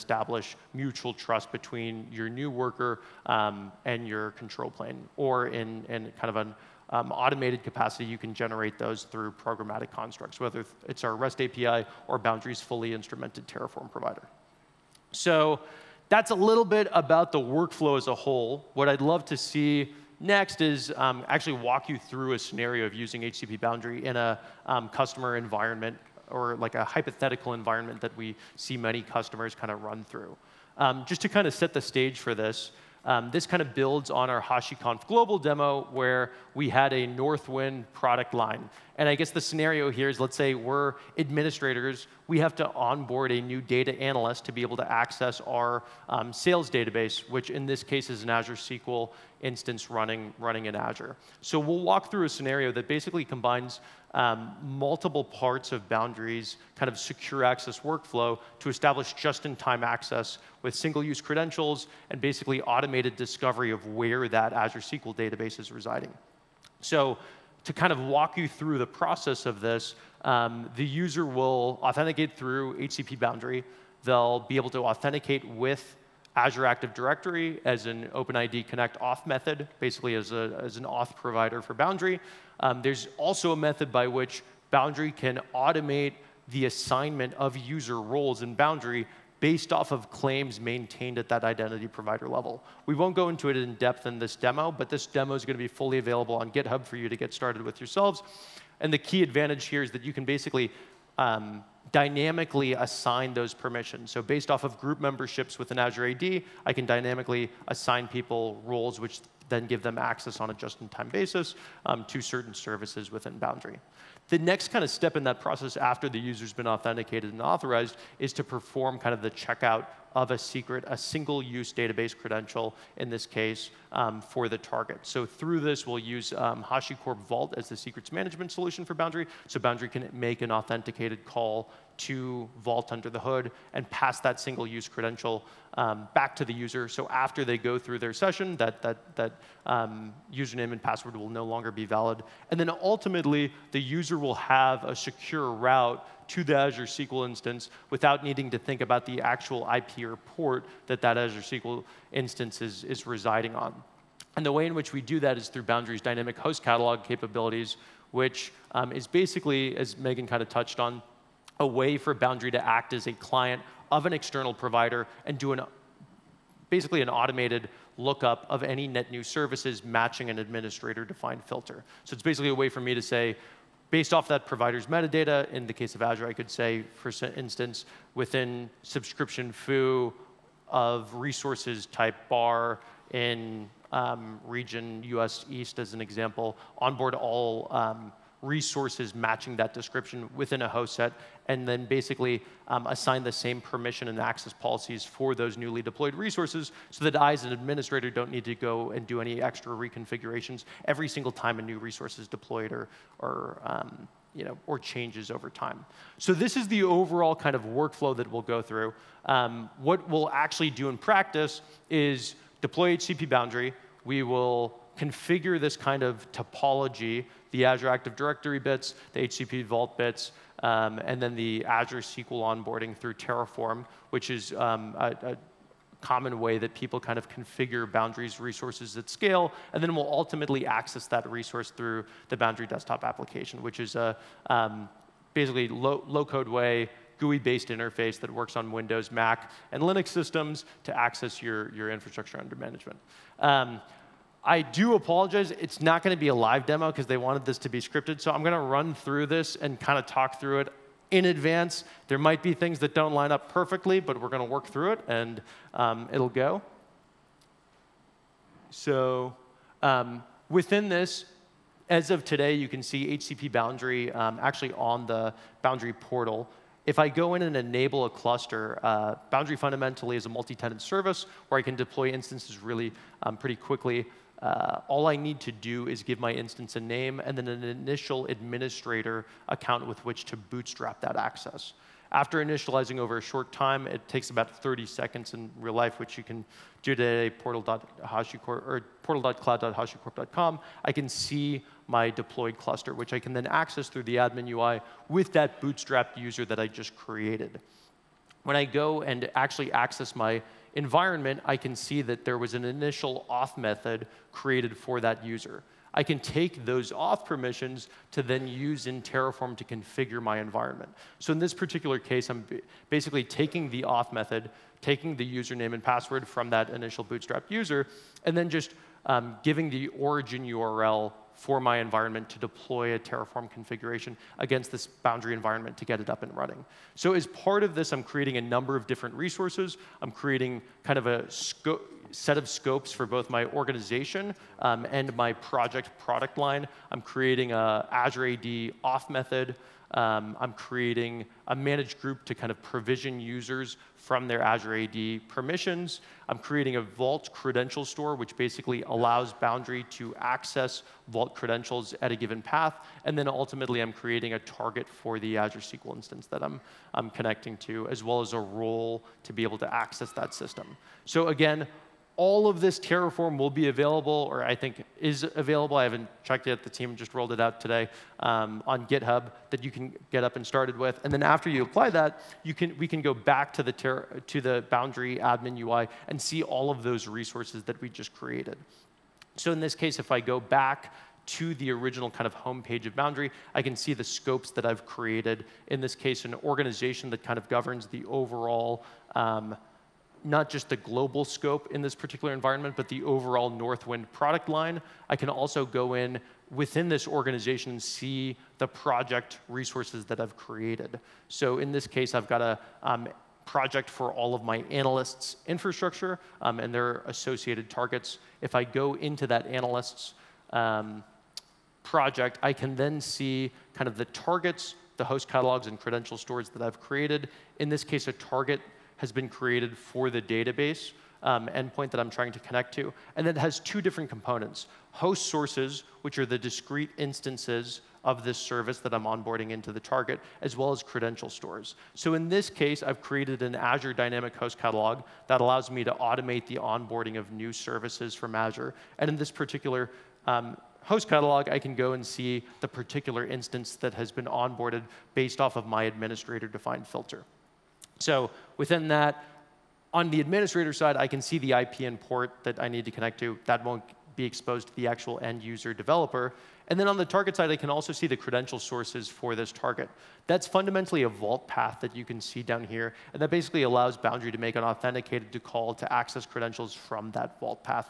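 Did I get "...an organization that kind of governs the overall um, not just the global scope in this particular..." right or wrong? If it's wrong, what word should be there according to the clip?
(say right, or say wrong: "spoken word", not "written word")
right.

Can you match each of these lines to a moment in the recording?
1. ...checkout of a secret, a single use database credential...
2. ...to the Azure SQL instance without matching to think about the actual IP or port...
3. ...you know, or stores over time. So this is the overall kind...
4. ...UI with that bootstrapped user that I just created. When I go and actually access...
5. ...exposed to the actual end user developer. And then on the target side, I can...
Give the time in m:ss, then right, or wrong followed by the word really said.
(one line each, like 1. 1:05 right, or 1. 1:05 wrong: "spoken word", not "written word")
1. 1:59 right
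2. 2:26 wrong: "needing", not "matching"
3. 3:24 wrong: "changes", not "stores"
4. 4:54 right
5. 7:34 right.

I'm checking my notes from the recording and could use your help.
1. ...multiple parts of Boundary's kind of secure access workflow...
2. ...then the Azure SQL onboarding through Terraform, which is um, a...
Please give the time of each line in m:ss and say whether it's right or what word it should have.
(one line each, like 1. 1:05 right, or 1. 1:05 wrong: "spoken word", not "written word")
1. 0:54 right
2. 3:41 right.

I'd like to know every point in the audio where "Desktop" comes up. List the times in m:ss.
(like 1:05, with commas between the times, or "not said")
3:52.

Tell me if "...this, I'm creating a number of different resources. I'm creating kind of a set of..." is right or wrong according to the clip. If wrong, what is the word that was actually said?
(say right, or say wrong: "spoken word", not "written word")
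right.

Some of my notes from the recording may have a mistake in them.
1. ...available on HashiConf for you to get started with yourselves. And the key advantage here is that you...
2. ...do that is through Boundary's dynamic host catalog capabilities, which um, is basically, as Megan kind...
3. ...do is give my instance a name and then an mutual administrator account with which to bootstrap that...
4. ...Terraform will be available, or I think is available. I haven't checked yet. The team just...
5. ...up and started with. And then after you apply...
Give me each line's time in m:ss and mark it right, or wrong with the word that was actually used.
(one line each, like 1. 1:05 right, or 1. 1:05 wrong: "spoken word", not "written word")
1. 1:35 wrong: "GitHub", not "HashiConf"
2. 2:34 right
3. 4:35 wrong: "initial", not "mutual"
4. 6:02 right
5. 6:10 right.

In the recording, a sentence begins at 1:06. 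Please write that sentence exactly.
So to kind of walk you through the process of this, um, the user will authenticate through HCP Boundary.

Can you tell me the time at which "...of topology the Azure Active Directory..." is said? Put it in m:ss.
3:36.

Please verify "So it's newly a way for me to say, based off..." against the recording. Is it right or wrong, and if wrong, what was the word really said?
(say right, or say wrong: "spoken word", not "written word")
wrong: "basically", not "newly".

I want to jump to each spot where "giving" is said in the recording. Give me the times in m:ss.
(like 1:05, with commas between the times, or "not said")
5:19.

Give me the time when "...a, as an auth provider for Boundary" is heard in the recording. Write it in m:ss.
1:20.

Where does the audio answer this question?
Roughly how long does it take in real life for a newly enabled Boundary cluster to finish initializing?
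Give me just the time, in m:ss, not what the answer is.
4:44.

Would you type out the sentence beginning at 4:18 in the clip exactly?
So um, within this, as of today, you can see HCP Boundary um, actually on the Boundary portal.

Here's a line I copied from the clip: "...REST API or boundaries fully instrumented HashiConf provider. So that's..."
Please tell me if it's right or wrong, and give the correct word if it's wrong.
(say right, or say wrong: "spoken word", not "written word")
wrong: "Terraform", not "HashiConf".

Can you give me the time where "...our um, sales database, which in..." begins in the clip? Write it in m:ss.
0:45.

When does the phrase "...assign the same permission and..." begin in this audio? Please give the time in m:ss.
3:12.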